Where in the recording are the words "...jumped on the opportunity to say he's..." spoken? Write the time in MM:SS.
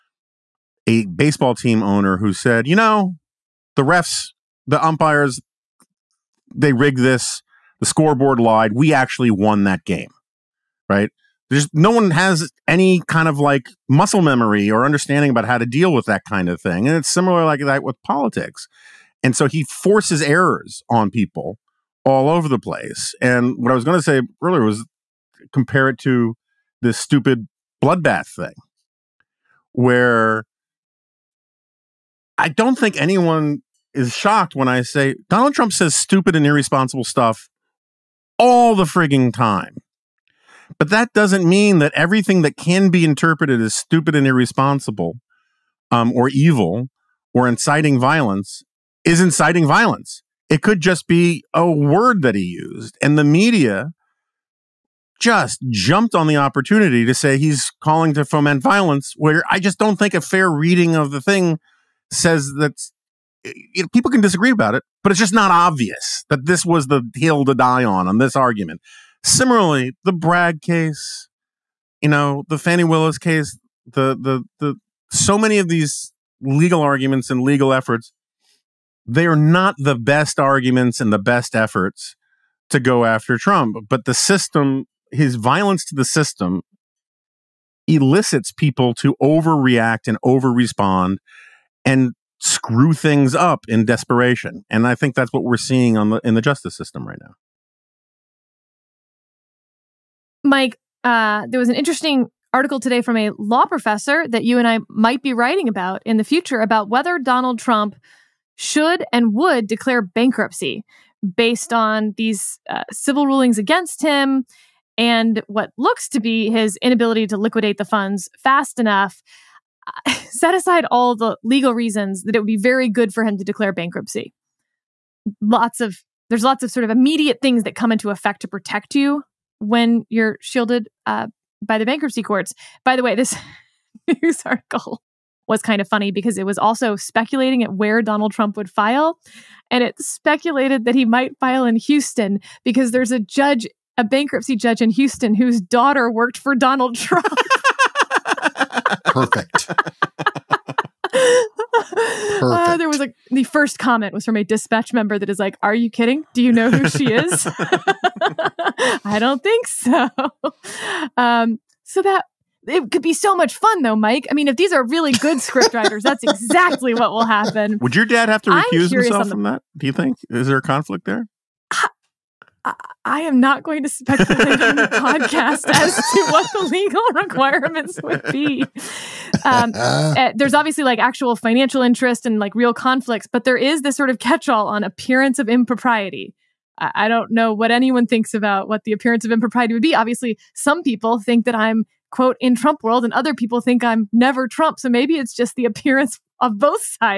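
00:55.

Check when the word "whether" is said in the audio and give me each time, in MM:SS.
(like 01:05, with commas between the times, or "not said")
01:46.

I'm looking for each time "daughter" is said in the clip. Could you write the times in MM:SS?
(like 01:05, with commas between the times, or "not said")
02:25.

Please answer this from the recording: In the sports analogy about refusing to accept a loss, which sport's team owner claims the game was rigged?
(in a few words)
baseball.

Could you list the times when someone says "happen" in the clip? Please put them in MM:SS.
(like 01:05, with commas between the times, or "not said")
02:47.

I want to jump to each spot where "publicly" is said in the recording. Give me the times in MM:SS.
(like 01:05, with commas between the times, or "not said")
not said.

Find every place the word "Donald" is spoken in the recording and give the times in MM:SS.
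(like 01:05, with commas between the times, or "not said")
00:35, 01:47, 02:18, 02:26.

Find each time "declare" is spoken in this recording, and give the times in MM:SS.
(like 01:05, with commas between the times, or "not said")
01:49, 02:03.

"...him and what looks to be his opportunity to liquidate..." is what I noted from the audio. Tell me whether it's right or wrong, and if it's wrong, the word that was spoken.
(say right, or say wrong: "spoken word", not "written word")
wrong: "inability", not "opportunity".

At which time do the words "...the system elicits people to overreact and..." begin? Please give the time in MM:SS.
01:25.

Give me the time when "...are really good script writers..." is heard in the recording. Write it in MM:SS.
02:44.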